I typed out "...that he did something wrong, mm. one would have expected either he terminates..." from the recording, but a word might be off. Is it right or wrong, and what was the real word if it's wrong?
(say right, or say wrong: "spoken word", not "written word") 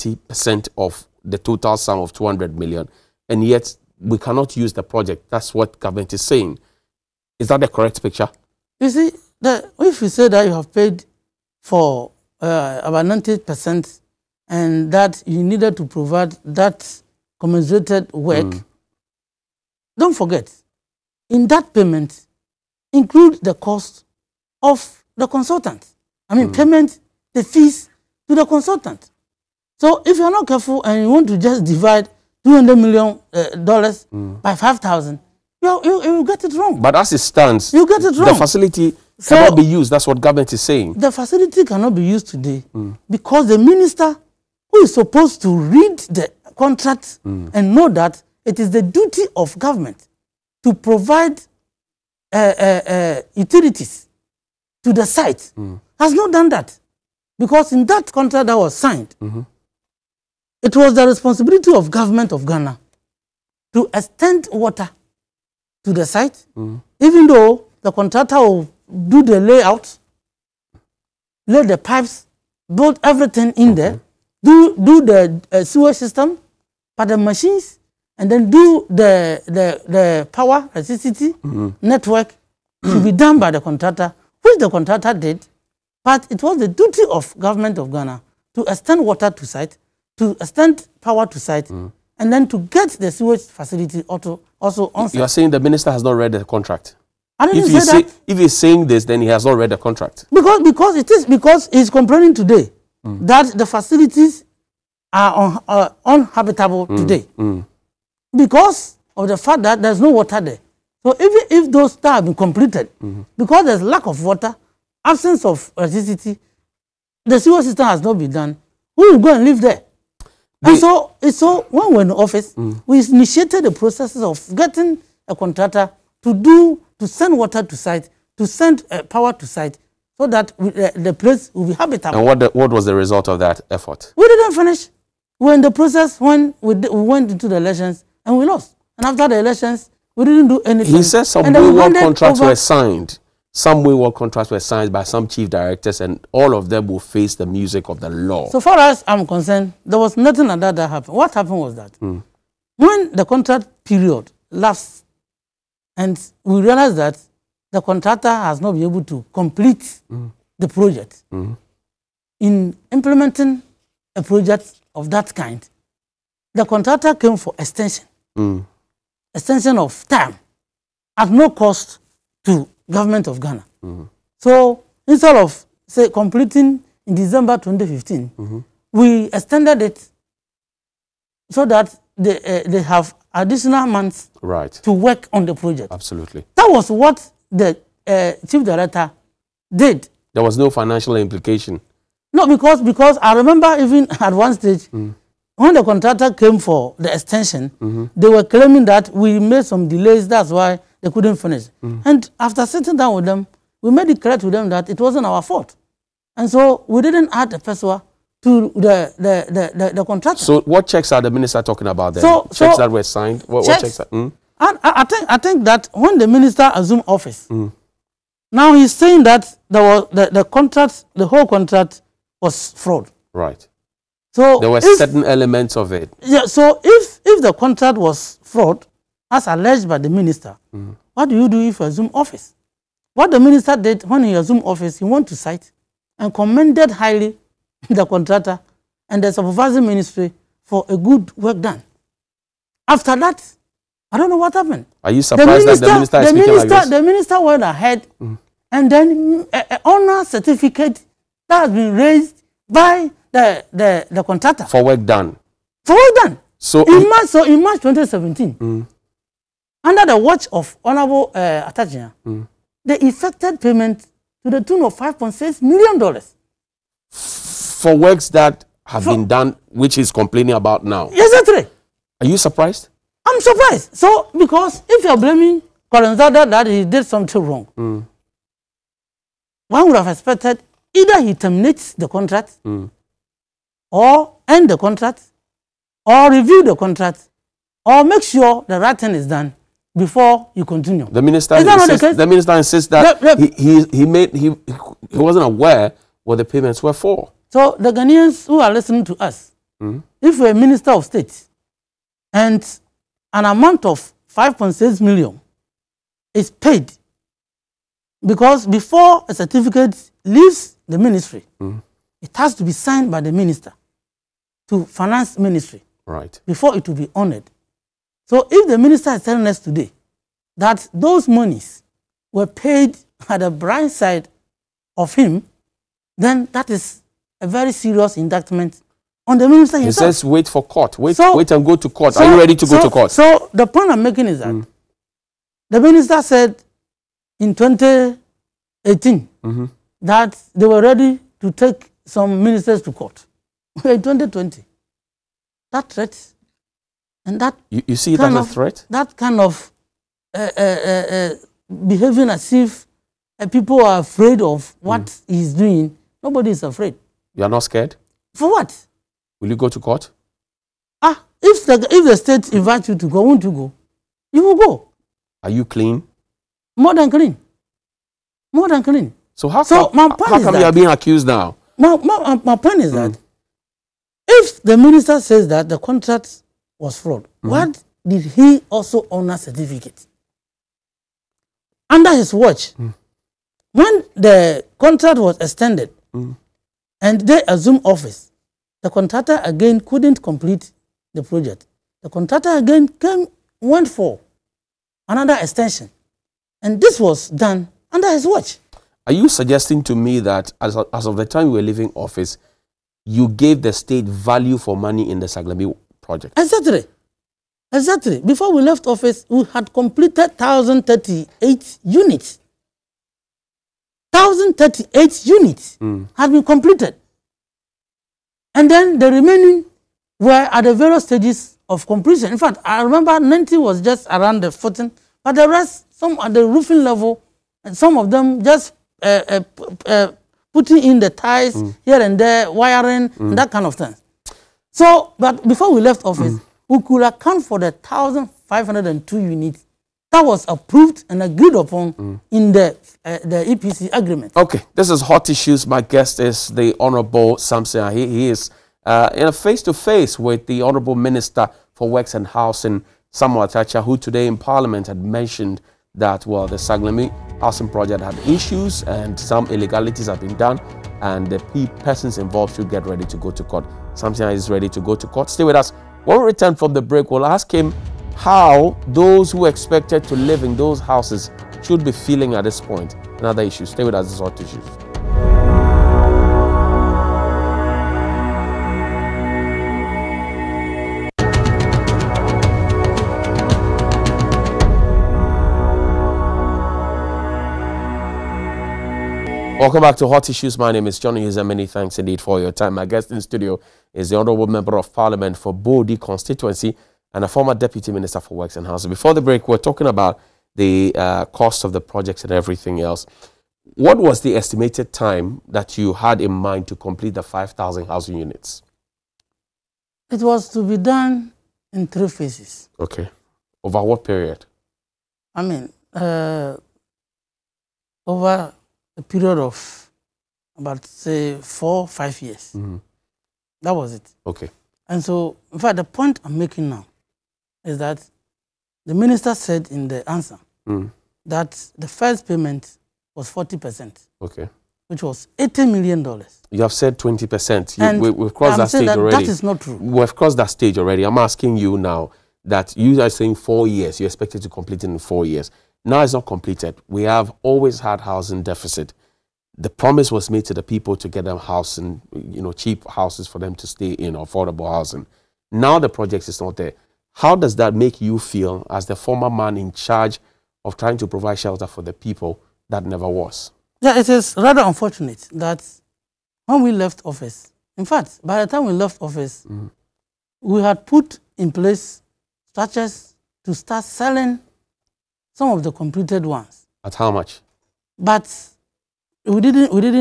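right.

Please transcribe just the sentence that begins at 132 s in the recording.
And what, the, what was the result of that effort?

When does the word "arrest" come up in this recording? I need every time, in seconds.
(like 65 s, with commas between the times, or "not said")
not said.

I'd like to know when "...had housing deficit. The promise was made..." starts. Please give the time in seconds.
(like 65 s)
547 s.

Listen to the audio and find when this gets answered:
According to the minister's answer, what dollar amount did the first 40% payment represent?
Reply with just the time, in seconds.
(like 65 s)
535 s.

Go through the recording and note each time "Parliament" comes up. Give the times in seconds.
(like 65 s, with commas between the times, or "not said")
454 s, 494 s.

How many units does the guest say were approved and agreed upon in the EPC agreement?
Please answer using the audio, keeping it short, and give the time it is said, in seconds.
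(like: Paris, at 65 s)
1,502, at 437 s.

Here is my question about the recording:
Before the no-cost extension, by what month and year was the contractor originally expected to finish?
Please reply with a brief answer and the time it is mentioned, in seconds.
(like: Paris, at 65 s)
December 2015, at 177 s.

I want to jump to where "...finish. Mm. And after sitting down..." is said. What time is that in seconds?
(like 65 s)
201 s.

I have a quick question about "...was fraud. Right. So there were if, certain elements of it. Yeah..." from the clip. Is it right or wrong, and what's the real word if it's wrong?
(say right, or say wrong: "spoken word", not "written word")
right.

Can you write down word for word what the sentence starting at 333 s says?
So the point I'm making is that mm.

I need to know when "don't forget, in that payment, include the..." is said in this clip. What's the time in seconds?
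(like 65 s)
19 s.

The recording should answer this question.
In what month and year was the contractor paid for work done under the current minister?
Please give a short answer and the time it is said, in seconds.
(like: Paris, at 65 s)
March 2017, at 257 s.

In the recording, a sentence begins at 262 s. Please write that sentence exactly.
they effected payment to the tune of $5.6 million.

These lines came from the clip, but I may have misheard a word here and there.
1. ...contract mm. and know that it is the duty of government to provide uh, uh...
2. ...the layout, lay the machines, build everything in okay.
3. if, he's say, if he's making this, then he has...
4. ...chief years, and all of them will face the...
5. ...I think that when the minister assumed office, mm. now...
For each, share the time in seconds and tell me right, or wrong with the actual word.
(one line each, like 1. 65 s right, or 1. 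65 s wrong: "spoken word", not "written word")
1. 46 s right
2. 69 s wrong: "pipes", not "machines"
3. 97 s wrong: "saying", not "making"
4. 145 s wrong: "directors", not "years"
5. 215 s right.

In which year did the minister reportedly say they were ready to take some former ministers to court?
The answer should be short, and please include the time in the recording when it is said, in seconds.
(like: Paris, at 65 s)
2018, at 337 s.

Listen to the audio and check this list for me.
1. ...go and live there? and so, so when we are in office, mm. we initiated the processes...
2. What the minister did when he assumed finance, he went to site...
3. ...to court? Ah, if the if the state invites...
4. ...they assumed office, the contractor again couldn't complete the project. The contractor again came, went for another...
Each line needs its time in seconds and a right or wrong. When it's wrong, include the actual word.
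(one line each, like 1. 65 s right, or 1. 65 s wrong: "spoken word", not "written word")
1. 119 s right
2. 233 s wrong: "office", not "finance"
3. 359 s right
4. 387 s right.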